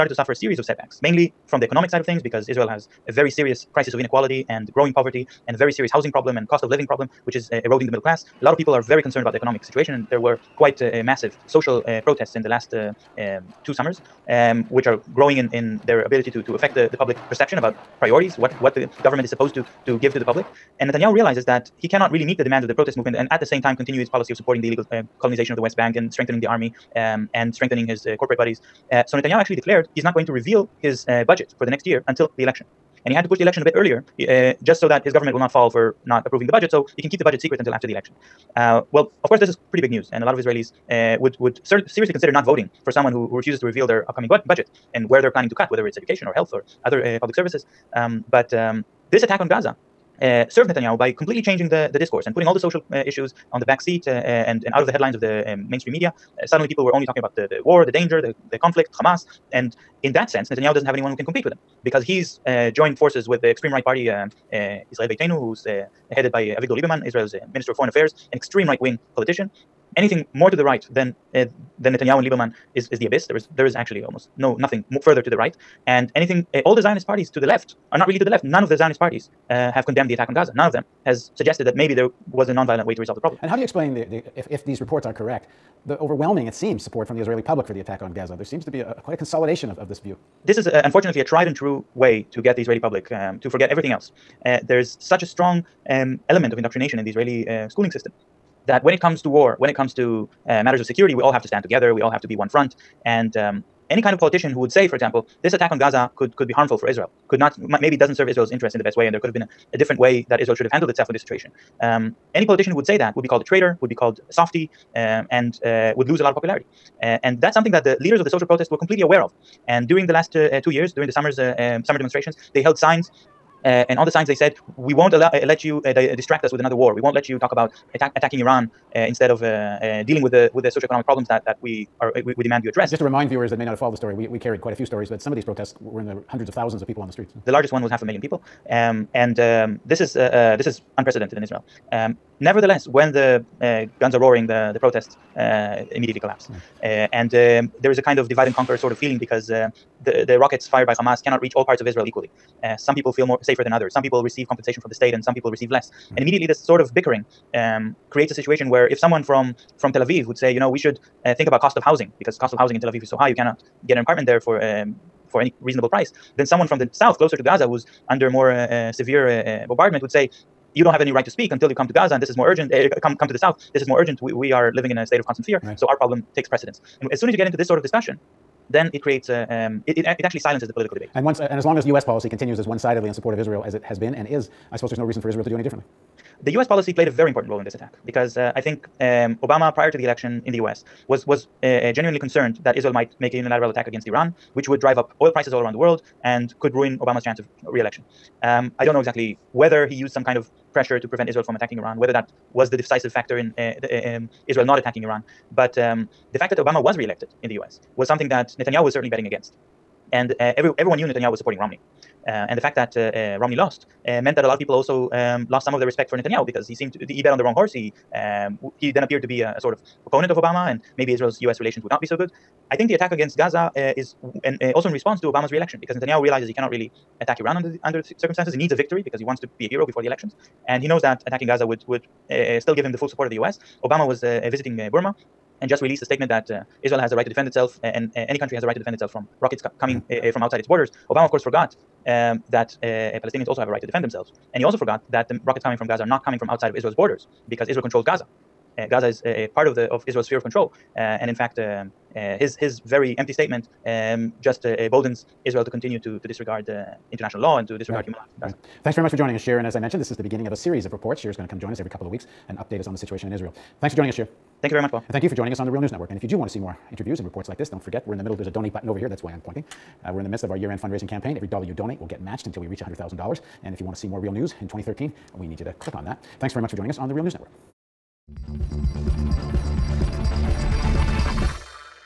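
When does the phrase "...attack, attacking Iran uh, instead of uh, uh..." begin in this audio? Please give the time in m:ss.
2:07.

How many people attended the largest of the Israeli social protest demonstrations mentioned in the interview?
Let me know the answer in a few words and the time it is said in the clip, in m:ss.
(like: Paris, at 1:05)
half a million, at 2:17.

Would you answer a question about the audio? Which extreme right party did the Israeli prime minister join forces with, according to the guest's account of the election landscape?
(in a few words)
Israel Beitenu.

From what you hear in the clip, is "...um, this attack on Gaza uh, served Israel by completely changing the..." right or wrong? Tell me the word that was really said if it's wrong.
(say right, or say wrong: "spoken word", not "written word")
wrong: "Netanyahu", not "Israel".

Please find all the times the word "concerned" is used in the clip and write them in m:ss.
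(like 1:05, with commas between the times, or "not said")
0:09, 3:12.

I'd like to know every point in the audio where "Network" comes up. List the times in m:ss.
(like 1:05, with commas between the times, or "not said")
4:25, 4:37.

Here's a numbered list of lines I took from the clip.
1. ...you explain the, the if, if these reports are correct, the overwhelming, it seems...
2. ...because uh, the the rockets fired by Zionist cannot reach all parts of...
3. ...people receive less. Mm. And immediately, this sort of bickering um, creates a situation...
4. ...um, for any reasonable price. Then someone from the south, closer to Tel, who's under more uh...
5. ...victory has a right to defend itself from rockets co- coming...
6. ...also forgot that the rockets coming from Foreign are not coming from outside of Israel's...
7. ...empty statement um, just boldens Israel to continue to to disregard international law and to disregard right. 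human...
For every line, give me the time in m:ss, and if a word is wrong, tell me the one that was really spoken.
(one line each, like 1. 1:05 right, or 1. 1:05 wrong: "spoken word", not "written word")
1. 1:23 right
2. 2:29 wrong: "Hamas", not "Zionist"
3. 2:35 right
4. 2:44 wrong: "Gaza", not "Tel"
5. 3:58 wrong: "country", not "victory"
6. 4:04 wrong: "Gaza", not "Foreign"
7. 4:13 right.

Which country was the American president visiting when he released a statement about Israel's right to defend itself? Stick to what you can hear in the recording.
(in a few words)
Burma.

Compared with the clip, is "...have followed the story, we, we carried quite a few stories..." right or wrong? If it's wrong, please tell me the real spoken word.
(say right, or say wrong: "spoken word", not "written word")
right.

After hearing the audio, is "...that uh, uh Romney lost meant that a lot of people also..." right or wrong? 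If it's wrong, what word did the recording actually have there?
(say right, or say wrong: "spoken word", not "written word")
right.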